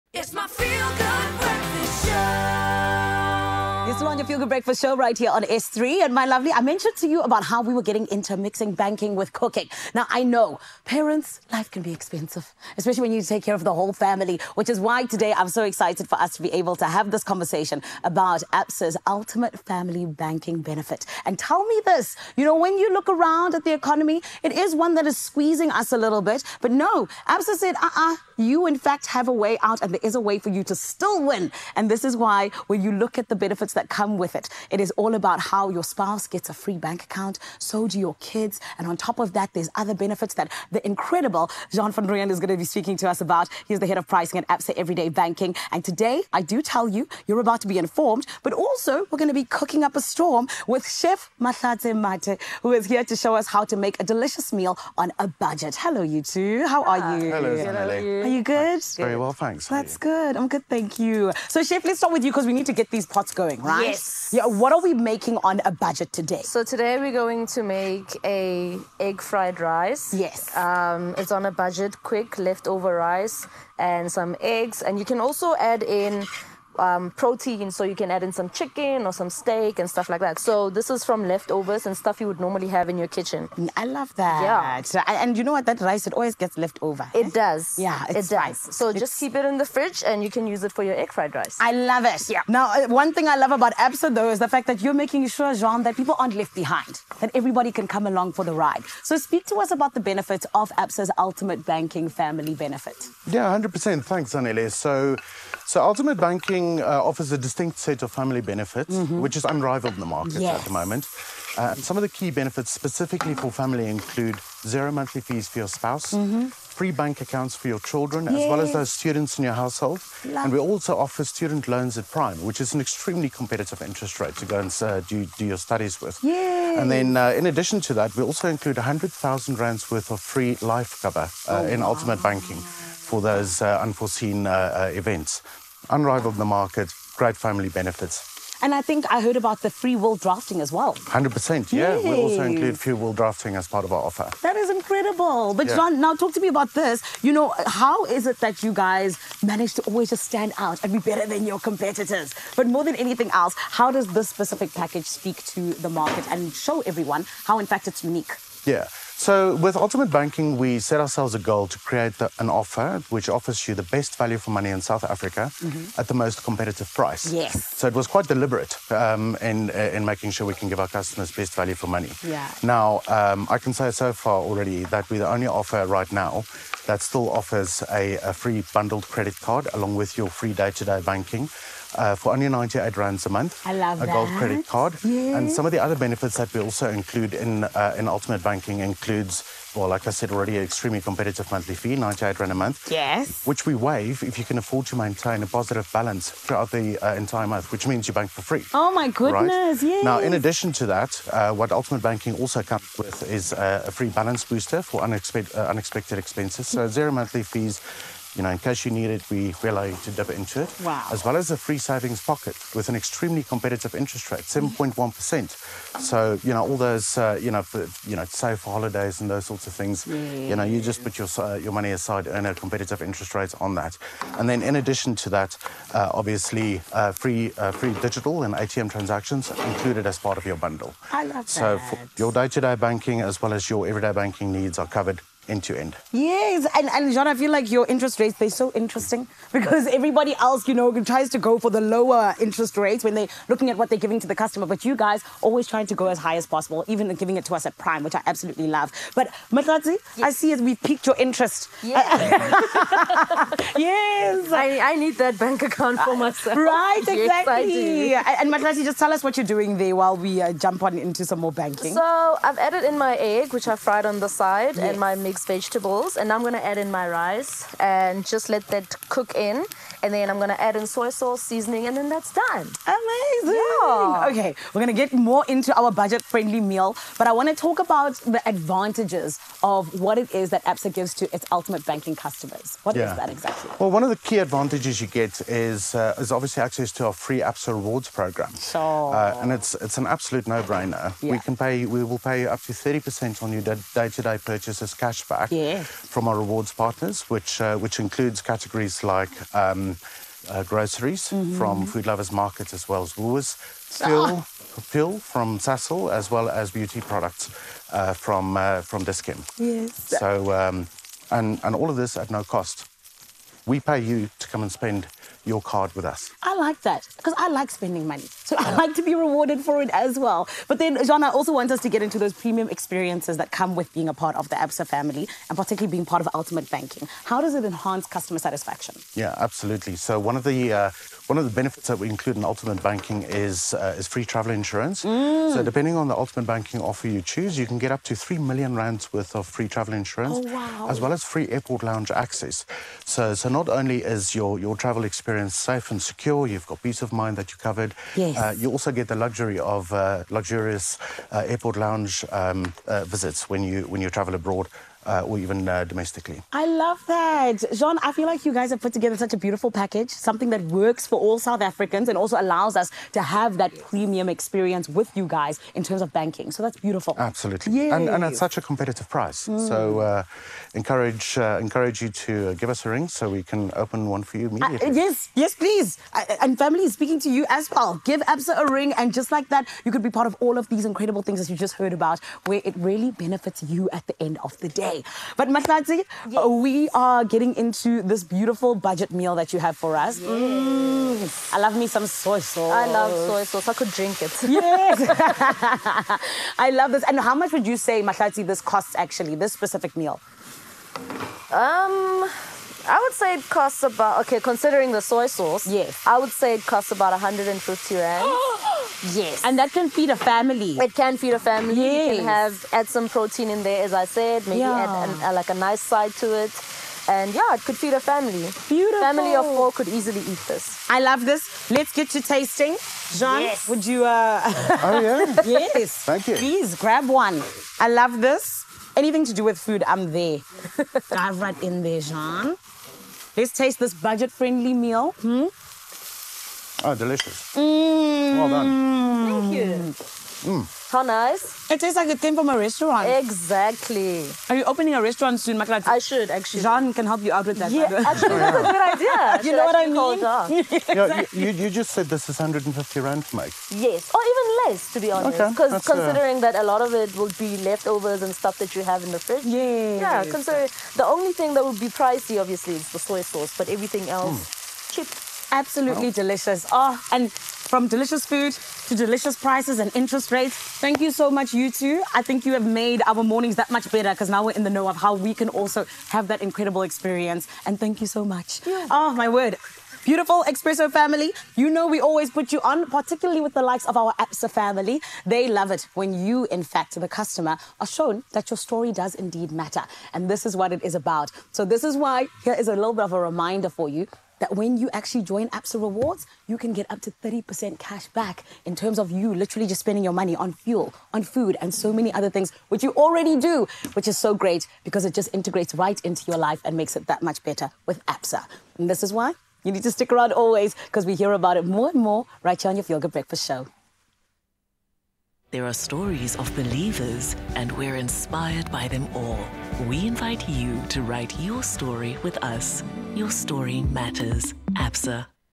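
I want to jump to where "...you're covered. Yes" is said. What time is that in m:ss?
5:47.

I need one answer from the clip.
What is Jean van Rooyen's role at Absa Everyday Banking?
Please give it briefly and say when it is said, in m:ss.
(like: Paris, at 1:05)
head of pricing, at 0:43.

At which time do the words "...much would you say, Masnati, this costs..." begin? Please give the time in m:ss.
6:37.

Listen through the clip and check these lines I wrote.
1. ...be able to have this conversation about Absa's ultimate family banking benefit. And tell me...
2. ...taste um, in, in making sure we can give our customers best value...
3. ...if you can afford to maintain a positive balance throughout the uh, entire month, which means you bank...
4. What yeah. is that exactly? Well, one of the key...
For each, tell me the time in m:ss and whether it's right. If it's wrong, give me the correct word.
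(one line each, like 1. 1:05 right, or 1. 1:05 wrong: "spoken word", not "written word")
1. 0:16 right
2. 2:48 wrong: "deliberate", not "taste"
3. 3:14 right
4. 4:42 right.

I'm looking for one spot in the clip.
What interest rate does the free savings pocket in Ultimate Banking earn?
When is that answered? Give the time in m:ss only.
3:34.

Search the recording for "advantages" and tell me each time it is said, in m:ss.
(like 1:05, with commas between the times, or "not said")
4:38, 4:44.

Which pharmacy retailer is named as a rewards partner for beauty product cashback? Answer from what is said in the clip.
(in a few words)
Dis-Chem.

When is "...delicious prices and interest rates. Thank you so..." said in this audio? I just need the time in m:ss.
7:48.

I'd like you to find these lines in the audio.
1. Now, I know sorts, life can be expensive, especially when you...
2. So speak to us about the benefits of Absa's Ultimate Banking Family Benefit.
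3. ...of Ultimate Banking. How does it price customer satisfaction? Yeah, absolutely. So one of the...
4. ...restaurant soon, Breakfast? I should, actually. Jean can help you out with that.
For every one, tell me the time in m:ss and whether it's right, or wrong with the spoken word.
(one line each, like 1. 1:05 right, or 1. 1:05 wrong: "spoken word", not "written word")
1. 0:09 wrong: "parents", not "sorts"
2. 1:39 right
3. 5:26 wrong: "enhance", not "price"
4. 7:25 wrong: "Makala", not "Breakfast".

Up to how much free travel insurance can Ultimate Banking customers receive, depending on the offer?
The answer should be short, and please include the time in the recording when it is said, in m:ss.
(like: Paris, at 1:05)
3 million rands, at 5:38.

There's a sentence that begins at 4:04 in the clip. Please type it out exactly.
But you guys always trying to go as high as possible, even giving it to us at prime, which I absolutely love.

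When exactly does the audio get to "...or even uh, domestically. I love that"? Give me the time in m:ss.
5:55.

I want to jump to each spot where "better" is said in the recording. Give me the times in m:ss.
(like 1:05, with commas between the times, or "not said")
2:30, 7:53, 8:27.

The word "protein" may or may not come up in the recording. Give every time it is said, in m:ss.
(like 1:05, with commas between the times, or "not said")
1:17, 6:53.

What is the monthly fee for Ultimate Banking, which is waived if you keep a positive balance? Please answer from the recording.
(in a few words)
98 rands.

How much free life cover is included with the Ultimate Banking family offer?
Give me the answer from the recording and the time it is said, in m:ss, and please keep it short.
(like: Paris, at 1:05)
100,000 rands, at 2:08.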